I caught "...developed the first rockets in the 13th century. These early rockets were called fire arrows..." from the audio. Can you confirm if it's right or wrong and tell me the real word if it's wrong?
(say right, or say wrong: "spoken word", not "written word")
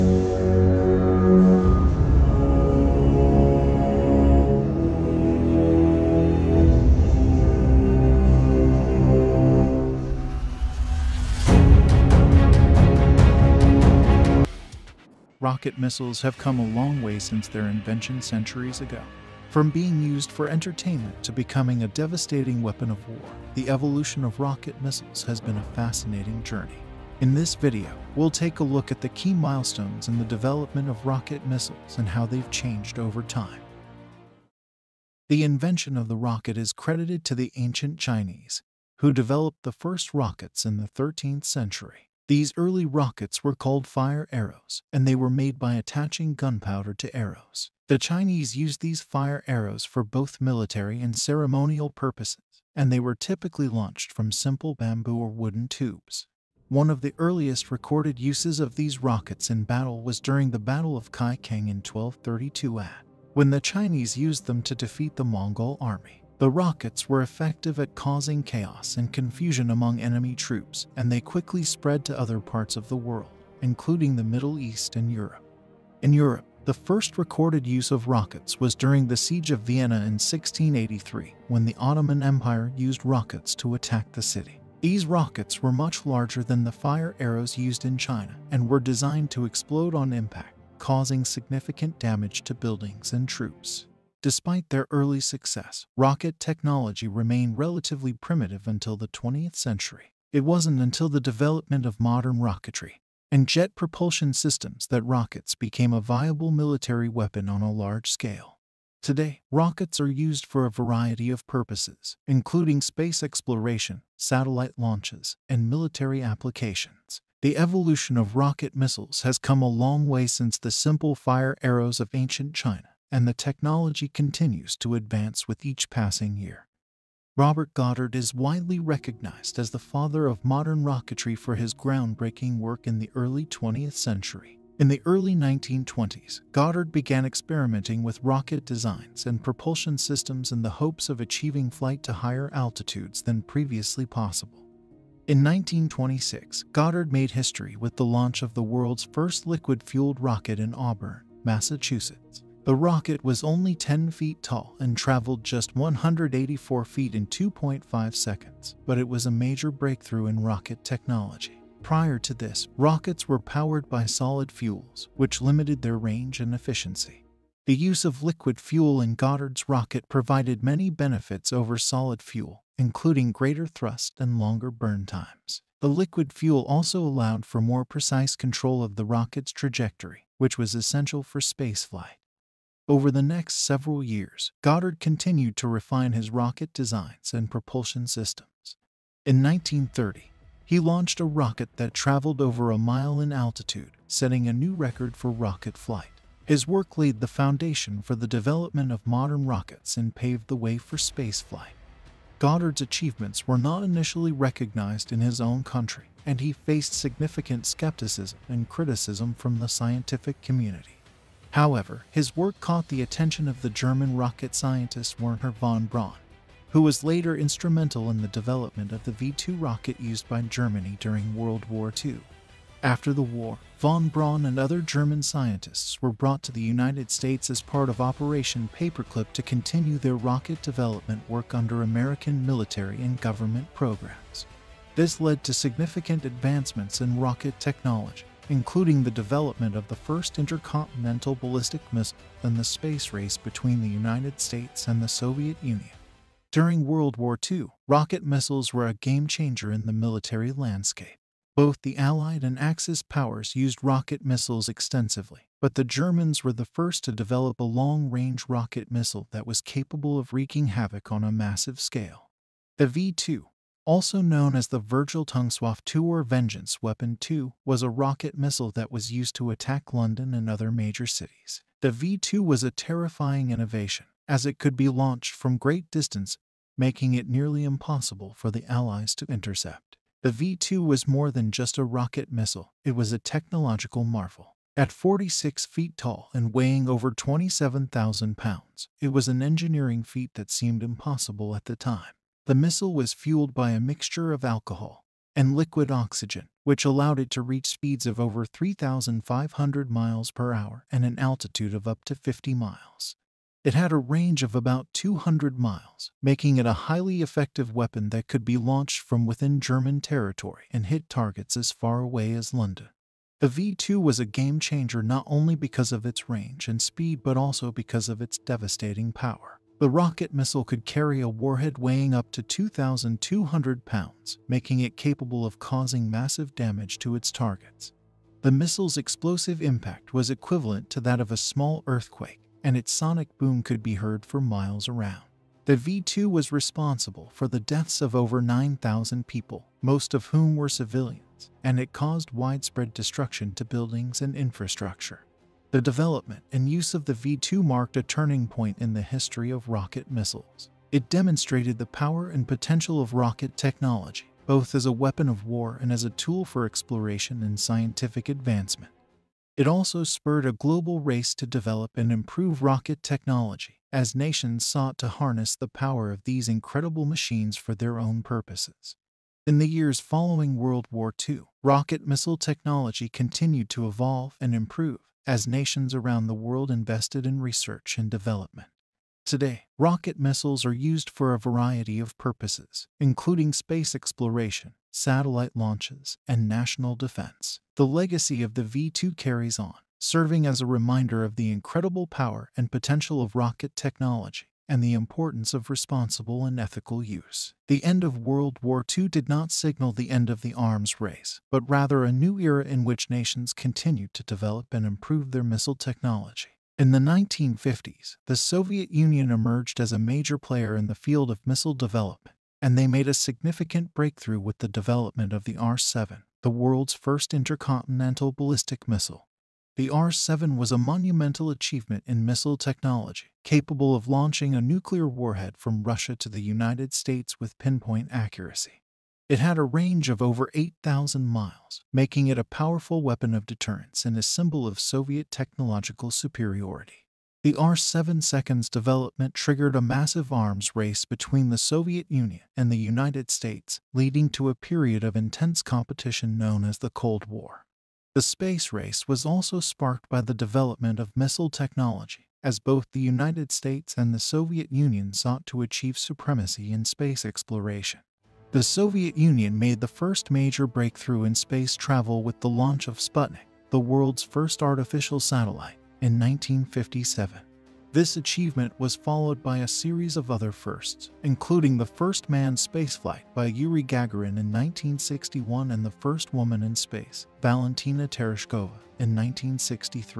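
right.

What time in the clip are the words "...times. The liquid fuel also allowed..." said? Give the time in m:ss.
2:55.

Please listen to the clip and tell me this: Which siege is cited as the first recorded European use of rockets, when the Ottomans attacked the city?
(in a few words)
Siege of Vienna.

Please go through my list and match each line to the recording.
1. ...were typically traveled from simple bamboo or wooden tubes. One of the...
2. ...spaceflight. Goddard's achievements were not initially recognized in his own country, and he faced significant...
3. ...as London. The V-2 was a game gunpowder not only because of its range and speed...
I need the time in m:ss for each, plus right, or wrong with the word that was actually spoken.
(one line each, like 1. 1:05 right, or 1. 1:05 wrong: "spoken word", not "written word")
1. 0:52 wrong: "launched", not "traveled"
2. 3:20 right
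3. 5:12 wrong: "changer", not "gunpowder".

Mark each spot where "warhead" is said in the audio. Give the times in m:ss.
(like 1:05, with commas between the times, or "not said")
5:21, 7:05.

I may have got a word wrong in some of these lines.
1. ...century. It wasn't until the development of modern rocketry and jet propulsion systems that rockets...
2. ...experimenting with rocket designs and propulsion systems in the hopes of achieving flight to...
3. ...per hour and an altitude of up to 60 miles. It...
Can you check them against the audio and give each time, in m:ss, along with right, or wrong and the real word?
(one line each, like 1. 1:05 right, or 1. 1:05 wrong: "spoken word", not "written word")
1. 1:39 right
2. 2:17 right
3. 5:00 wrong: "50", not "60".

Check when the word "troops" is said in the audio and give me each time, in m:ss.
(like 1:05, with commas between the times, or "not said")
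1:10, 1:33.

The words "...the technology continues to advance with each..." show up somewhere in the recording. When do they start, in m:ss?
2:03.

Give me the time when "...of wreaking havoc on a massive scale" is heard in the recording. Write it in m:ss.
4:20.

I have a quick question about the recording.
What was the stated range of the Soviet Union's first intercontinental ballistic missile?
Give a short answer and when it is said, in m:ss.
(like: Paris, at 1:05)
over 8,000 miles, at 7:10.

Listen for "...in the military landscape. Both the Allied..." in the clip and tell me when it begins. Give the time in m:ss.
4:09.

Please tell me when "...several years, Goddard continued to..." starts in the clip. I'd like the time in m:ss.
3:03.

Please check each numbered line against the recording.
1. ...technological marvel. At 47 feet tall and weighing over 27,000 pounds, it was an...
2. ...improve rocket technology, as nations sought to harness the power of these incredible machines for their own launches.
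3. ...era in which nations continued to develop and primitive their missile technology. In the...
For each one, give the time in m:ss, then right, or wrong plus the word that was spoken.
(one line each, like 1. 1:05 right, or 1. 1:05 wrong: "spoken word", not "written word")
1. 4:43 wrong: "46", not "47"
2. 6:02 wrong: "purposes", not "launches"
3. 6:42 wrong: "improve", not "primitive".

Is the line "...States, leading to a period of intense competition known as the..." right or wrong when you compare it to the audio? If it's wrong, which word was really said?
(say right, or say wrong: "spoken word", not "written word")
right.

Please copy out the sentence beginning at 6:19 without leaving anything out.
Today, rocket missiles are used for a variety of purposes, including space exploration, satellite launches, and national defense.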